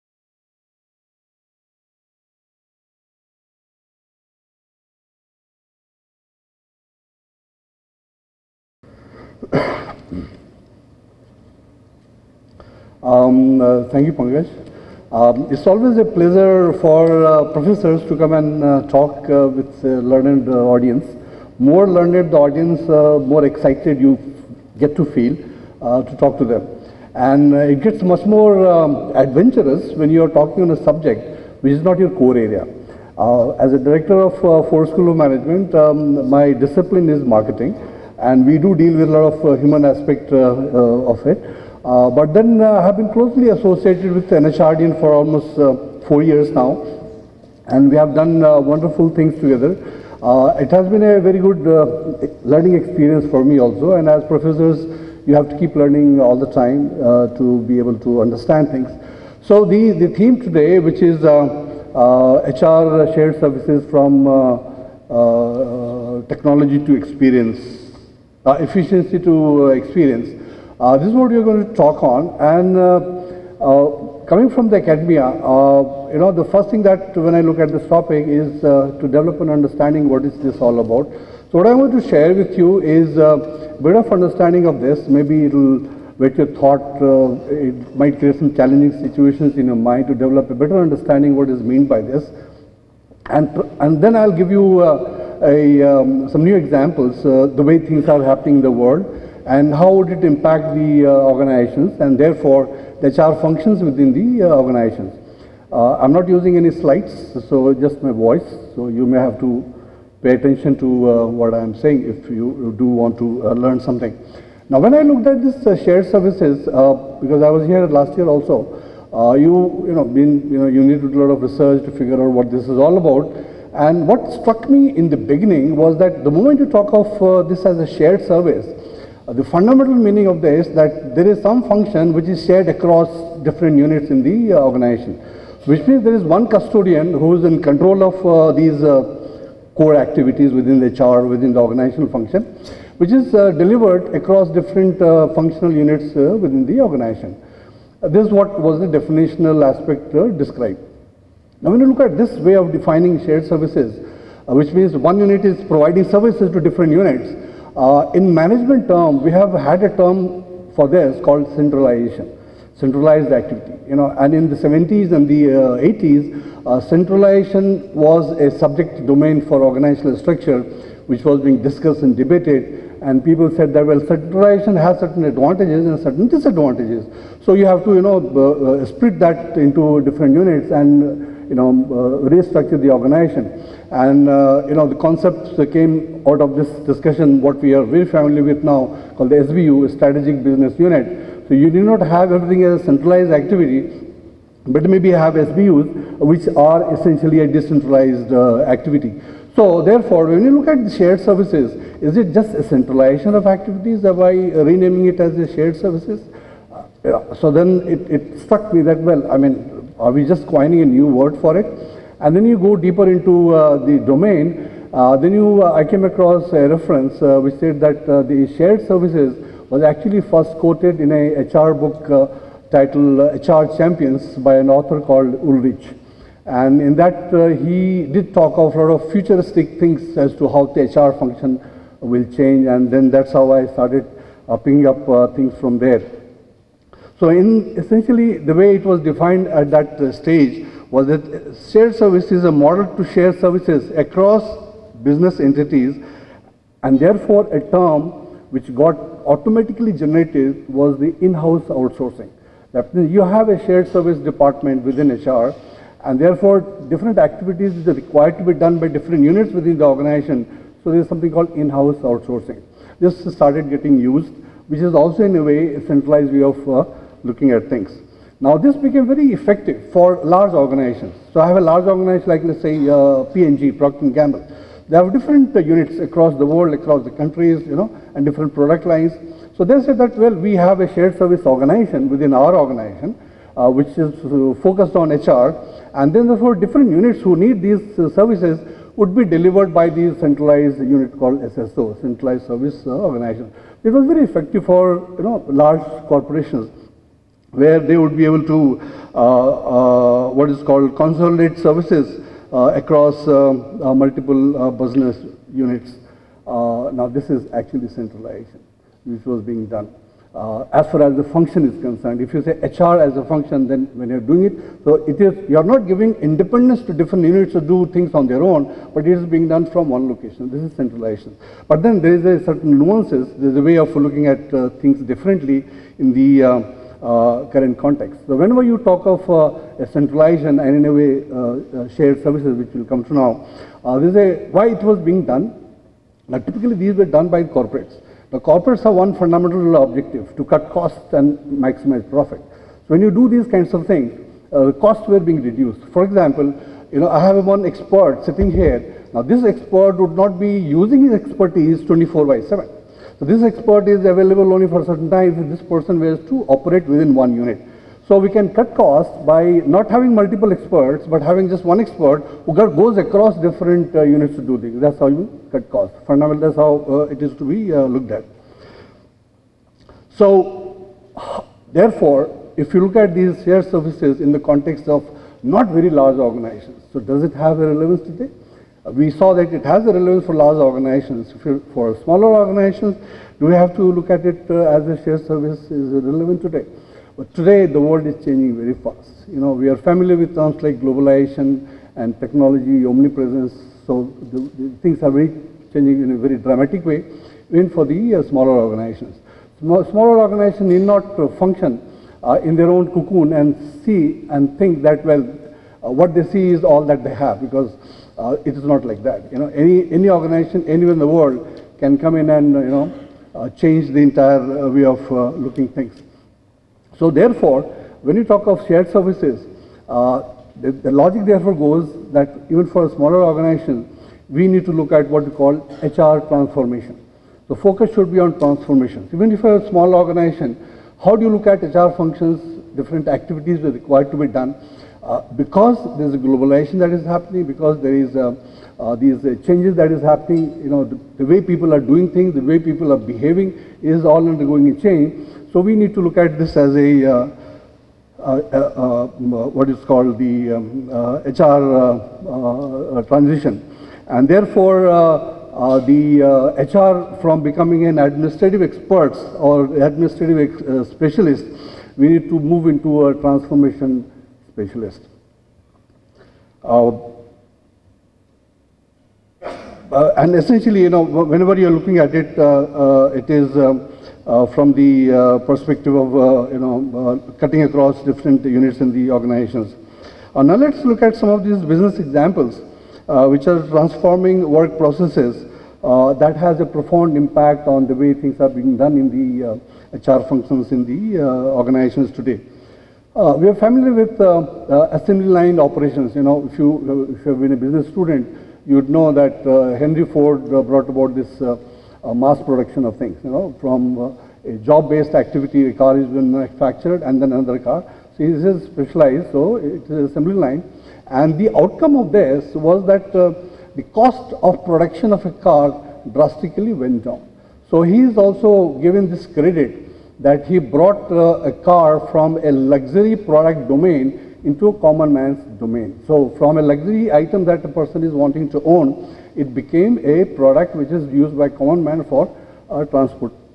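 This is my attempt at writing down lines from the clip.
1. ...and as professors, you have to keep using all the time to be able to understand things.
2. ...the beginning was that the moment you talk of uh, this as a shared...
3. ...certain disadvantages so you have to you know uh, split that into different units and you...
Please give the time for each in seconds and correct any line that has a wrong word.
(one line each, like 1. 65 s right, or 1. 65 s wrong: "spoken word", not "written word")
1. 53 s wrong: "learning", not "using"
2. 125 s right
3. 175 s right.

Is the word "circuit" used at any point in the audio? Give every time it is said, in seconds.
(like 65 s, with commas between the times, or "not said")
not said.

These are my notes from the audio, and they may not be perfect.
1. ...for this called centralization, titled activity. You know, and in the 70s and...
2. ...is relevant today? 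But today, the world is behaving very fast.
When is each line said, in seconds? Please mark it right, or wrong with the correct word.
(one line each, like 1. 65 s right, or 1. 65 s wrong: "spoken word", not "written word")
1. 160 s wrong: "centralized", not "titled"
2. 385 s wrong: "changing", not "behaving".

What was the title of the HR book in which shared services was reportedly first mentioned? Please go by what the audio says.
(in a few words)
HR Champions.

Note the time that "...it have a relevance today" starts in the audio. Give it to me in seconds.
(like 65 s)
377 s.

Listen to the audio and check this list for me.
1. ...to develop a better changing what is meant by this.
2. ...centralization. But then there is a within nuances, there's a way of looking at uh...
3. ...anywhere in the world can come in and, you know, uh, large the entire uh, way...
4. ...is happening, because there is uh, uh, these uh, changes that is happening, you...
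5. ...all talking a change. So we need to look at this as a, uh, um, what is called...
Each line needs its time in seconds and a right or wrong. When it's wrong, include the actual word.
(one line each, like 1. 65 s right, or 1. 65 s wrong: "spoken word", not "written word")
1. 90 s wrong: "understanding", not "changing"
2. 320 s wrong: "certain", not "within"
3. 410 s wrong: "change", not "large"
4. 436 s right
5. 444 s wrong: "undergoing", not "talking".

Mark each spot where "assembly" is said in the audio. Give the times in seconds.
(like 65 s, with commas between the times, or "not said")
494 s, 509 s.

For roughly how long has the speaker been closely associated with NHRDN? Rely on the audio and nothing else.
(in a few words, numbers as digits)
4 years.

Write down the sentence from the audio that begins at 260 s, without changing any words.
So there is something called in-house outsourcing.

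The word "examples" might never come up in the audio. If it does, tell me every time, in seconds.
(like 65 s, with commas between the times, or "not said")
96 s, 346 s, 482 s.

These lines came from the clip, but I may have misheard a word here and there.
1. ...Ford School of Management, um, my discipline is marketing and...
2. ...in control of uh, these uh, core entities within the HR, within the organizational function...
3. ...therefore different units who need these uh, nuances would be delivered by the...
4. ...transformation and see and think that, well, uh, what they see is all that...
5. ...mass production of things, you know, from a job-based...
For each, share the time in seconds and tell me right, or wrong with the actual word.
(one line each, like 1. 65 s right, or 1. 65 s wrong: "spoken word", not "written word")
1. 34 s right
2. 137 s wrong: "activities", not "entities"
3. 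286 s wrong: "services", not "nuances"
4. 402 s wrong: "cocoon", not "transformation"
5. 502 s right.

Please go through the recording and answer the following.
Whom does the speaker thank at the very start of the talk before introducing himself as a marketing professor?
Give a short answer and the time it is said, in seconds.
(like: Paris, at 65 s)
Pankaj, at 14 s.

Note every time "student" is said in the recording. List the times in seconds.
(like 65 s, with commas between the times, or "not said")
497 s.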